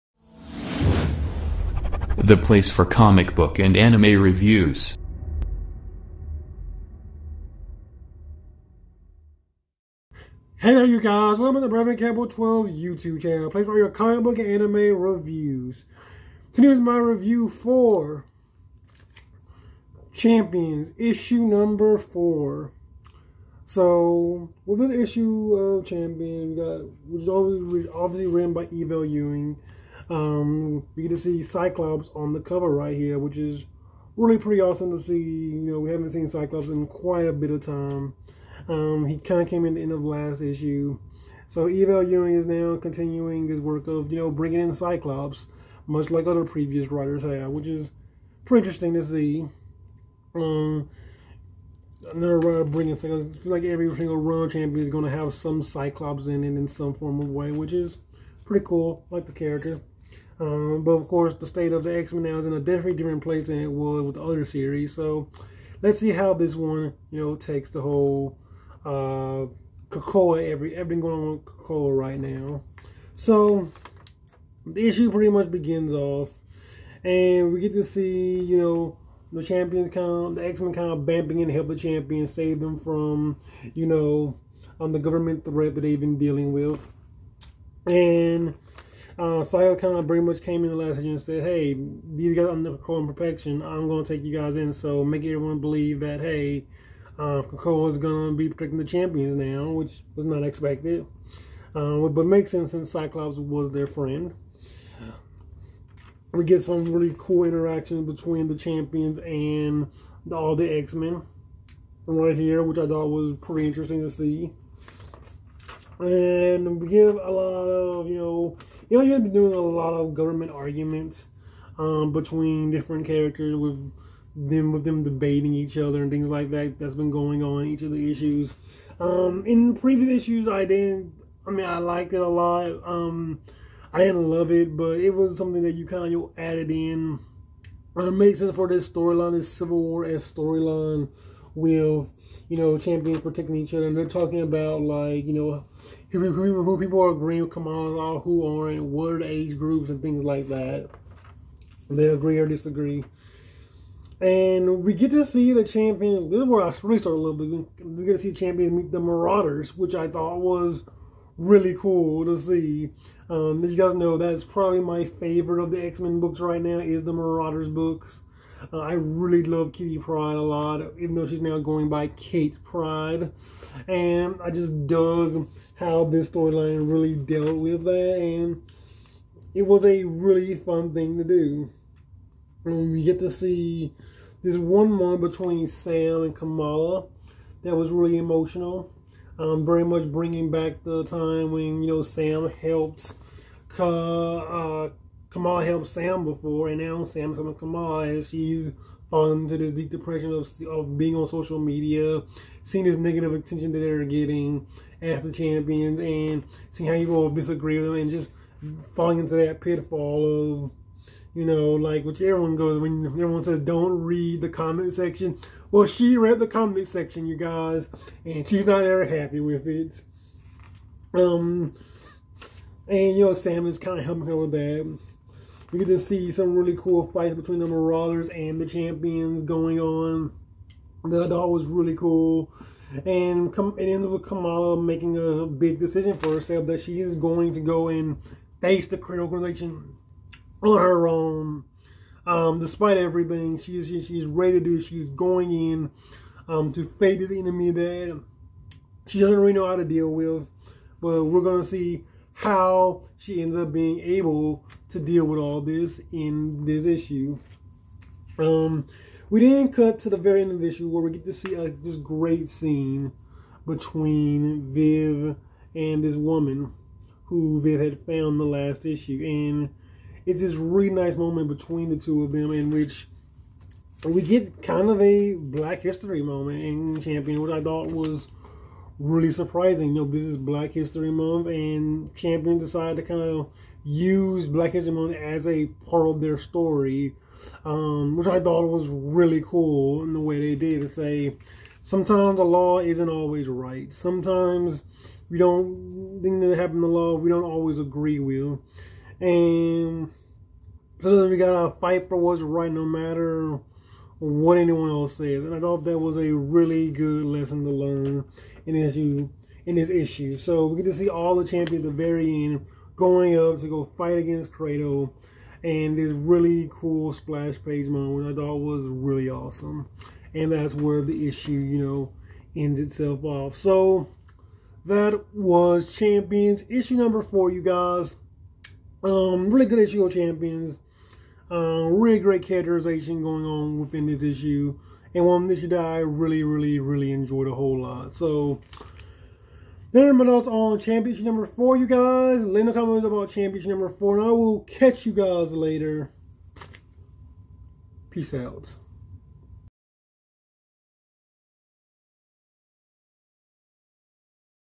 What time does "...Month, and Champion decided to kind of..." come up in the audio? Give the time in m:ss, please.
4:41.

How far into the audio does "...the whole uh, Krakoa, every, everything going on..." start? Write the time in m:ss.
1:07.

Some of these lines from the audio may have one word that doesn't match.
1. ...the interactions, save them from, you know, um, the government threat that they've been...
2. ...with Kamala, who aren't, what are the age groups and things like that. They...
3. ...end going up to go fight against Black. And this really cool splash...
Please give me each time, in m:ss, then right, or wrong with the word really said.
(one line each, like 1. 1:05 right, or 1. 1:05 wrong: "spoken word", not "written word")
1. 1:21 wrong: "champions", not "interactions"
2. 2:27 right
3. 5:12 wrong: "Kratos", not "Black".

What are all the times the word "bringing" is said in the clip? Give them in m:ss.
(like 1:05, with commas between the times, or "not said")
0:44, 0:52, 3:10.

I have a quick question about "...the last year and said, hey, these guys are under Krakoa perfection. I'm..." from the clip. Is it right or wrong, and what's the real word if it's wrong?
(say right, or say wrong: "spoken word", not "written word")
right.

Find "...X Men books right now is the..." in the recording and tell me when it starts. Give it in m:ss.
2:45.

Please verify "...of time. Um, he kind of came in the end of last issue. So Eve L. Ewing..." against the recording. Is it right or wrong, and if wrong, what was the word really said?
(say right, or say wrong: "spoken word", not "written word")
right.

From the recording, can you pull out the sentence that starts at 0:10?
Hey there you guys, welcome to the Brevin Campbell 12 YouTube channel, place for your comic book and anime reviews.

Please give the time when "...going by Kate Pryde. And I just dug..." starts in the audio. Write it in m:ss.
2:51.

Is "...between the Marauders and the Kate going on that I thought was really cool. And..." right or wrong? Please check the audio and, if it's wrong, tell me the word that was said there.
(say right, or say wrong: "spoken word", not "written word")
wrong: "Champions", not "Kate".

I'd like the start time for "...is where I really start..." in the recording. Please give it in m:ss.
2:36.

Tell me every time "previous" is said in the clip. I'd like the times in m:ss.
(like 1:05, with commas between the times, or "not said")
0:46, 2:09.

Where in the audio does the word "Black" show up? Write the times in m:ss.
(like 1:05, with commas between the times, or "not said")
4:35, 4:40, 4:44.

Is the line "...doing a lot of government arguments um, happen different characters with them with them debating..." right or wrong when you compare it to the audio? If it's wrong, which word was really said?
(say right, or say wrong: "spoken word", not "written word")
wrong: "between", not "happen".